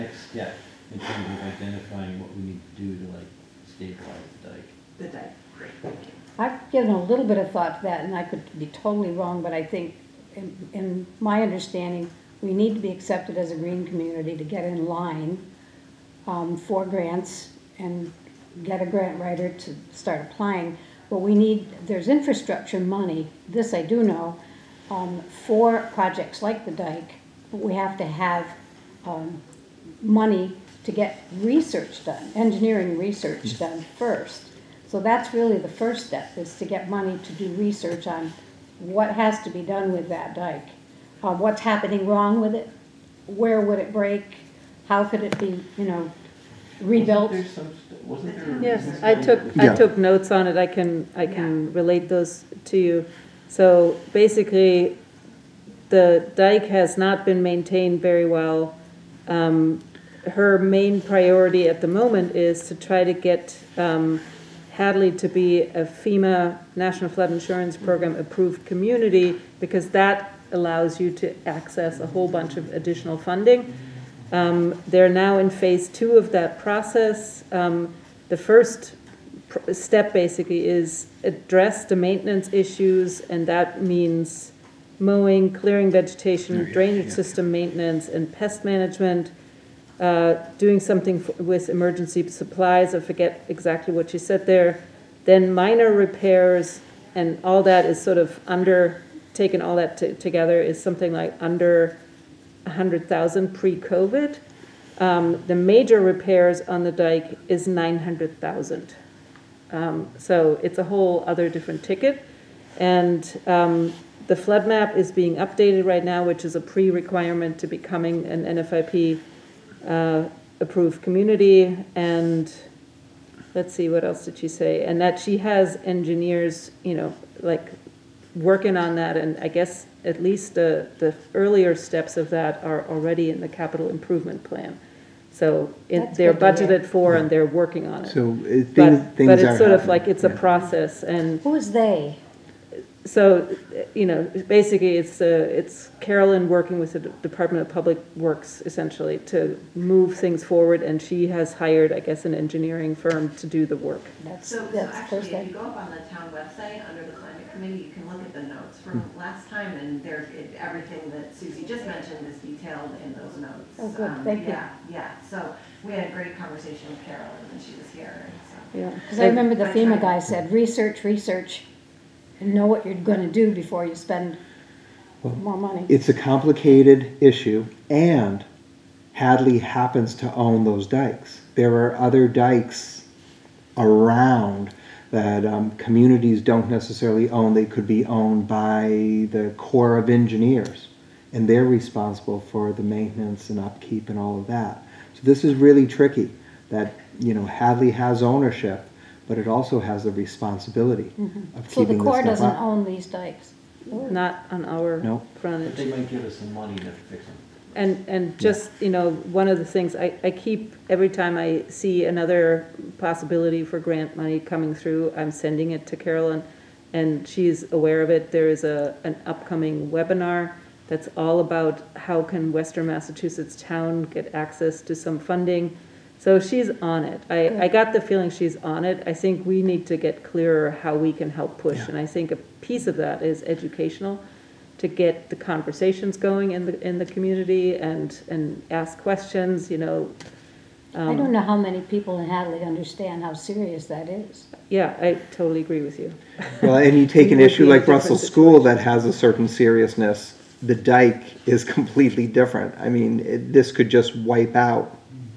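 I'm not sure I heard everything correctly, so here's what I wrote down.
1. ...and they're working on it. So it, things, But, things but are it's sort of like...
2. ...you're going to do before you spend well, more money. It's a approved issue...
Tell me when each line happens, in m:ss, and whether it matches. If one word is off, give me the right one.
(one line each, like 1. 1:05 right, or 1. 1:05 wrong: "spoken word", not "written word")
1. 2:17 right
2. 2:52 wrong: "complicated", not "approved".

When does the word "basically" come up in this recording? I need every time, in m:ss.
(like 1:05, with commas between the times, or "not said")
0:54, 1:20, 2:24.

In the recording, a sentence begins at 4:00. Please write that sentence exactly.
Um, I don't um, know how many people in Hadley understand how serious that is.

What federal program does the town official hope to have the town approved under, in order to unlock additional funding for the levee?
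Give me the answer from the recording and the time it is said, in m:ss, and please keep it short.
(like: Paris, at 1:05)
National Flood Insurance Program, at 1:06.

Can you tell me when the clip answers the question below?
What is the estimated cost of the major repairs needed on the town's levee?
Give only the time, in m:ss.
1:47.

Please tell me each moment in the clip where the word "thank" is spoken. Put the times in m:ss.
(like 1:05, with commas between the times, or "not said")
0:05, 2:44.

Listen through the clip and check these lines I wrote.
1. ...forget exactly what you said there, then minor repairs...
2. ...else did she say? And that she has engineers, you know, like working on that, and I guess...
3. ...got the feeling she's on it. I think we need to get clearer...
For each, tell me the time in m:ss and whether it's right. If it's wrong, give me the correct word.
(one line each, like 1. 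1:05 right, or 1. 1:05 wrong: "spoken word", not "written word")
1. 1:32 right
2. 2:04 right
3. 3:47 right.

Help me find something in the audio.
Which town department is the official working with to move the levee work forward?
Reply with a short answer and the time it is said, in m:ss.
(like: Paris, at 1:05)
Department of Public Works, at 2:26.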